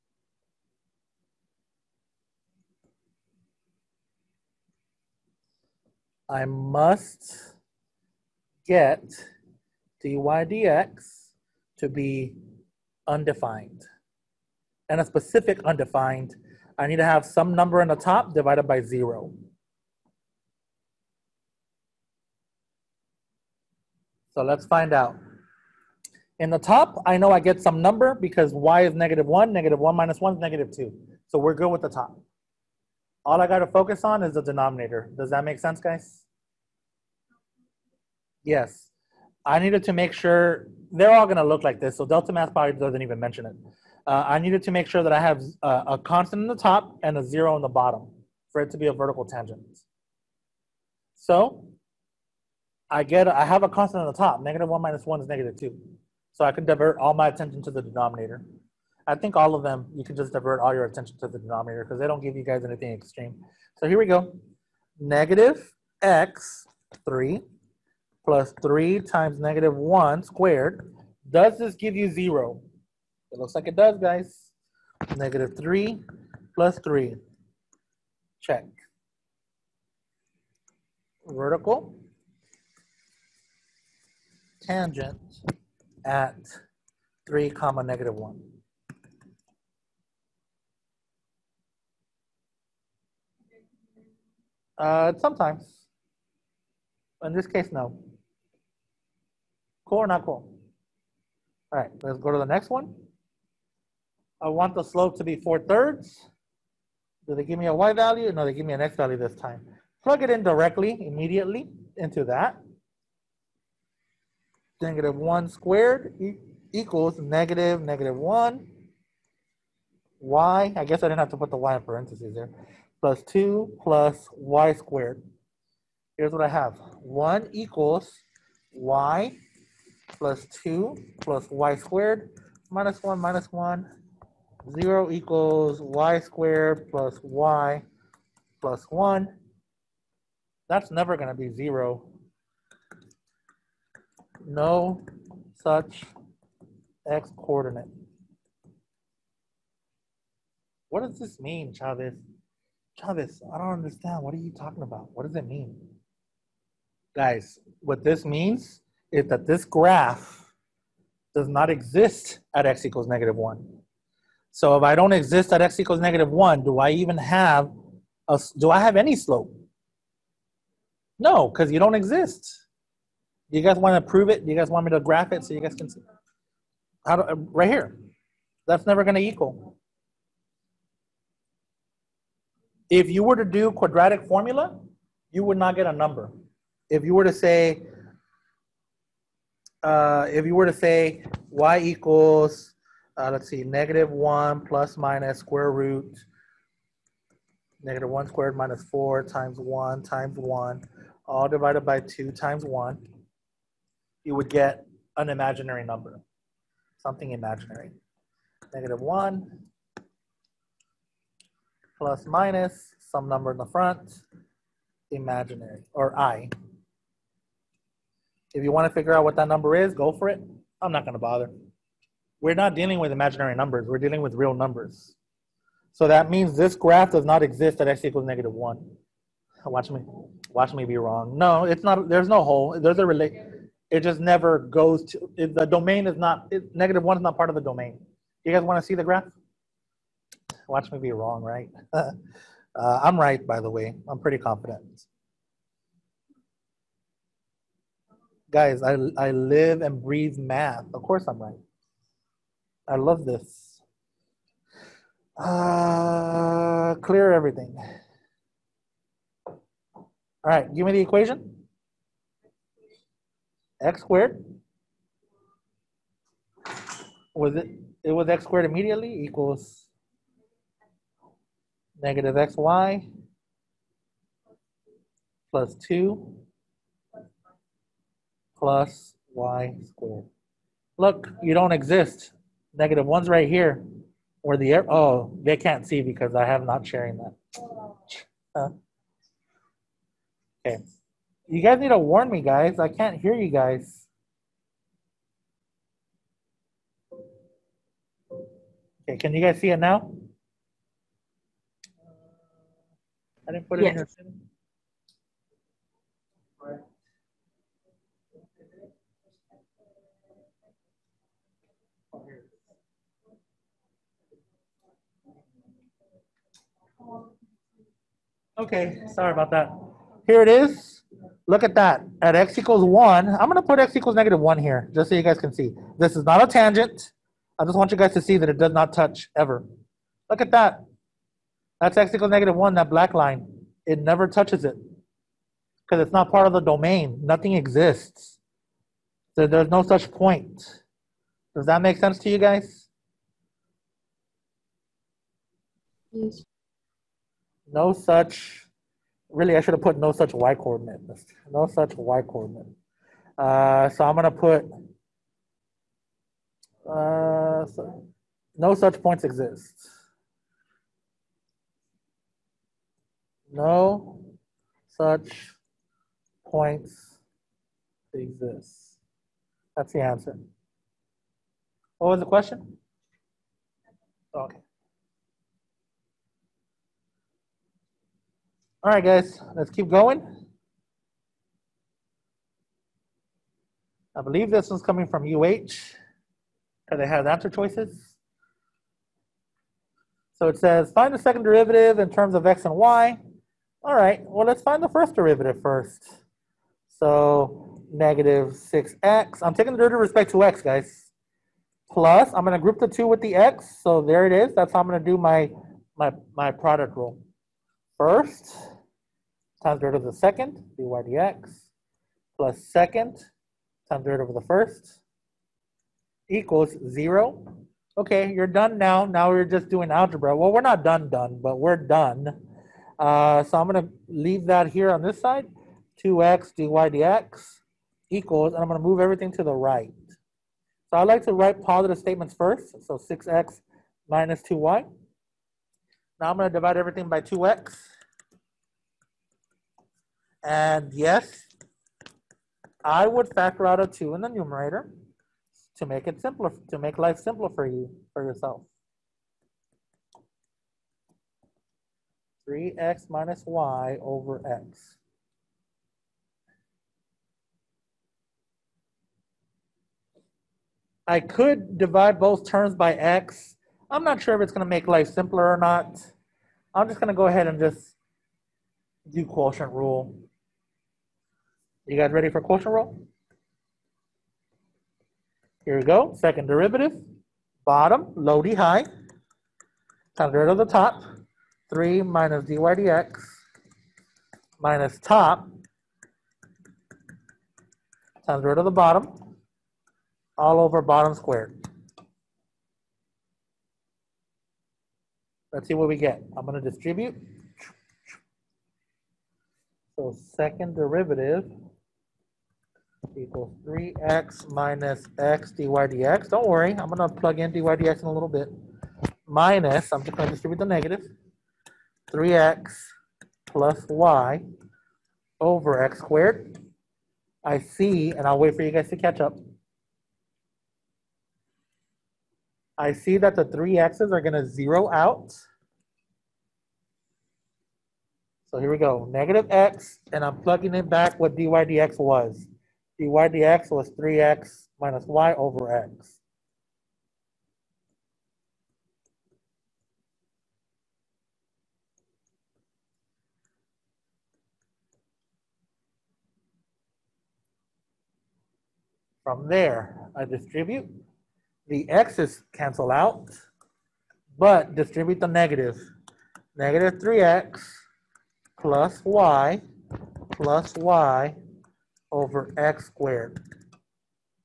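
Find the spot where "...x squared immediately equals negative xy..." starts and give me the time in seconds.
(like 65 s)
268 s.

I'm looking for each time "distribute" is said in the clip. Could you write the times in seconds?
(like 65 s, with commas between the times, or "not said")
496 s, 510 s, 550 s, 554 s.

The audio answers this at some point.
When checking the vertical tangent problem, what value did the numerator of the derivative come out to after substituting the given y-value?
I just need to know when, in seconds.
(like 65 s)
55 s.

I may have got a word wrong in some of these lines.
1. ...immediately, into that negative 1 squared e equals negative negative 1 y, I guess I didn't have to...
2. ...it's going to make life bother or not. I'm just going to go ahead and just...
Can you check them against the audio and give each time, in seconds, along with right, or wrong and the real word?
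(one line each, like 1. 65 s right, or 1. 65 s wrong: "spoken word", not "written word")
1. 111 s right
2. 464 s wrong: "simpler", not "bother".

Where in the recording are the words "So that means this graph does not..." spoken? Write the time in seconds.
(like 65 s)
225 s.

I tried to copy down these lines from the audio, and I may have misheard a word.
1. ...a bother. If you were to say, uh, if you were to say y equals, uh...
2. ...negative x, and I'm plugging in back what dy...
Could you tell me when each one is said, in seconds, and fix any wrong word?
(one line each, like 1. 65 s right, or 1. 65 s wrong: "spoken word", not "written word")
1. 185 s wrong: "number", not "bother"
2. 529 s right.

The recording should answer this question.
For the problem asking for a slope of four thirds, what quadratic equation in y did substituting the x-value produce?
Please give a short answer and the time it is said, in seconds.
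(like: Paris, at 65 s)
0 = y^2 + y + 1, at 134 s.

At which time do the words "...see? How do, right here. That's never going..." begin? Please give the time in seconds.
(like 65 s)
175 s.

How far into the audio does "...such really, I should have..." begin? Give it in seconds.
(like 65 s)
347 s.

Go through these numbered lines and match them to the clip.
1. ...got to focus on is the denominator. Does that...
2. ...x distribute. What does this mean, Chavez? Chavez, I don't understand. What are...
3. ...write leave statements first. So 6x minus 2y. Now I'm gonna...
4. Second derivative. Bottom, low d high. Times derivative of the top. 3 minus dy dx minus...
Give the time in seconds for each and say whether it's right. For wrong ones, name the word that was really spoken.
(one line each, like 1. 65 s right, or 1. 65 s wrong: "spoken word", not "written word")
1. 33 s right
2. 147 s wrong: "coordinate", not "distribute"
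3. 431 s wrong: "positive", not "leave"
4. 476 s right.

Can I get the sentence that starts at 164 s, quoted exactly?
So if I don't exist at x equals negative 1, do I even have a, do I have any slope?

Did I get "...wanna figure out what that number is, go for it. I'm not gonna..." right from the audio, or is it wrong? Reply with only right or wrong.
right.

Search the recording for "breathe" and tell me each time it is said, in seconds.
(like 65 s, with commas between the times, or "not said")
250 s.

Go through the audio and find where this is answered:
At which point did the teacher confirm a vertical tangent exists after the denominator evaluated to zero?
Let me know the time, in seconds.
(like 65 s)
87 s.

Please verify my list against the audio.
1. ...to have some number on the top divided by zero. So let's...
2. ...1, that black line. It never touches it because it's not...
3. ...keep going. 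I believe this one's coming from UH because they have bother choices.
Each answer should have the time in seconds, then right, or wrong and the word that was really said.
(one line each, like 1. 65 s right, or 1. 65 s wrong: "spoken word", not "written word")
1. 16 s right
2. 332 s right
3. 379 s wrong: "answer", not "bother".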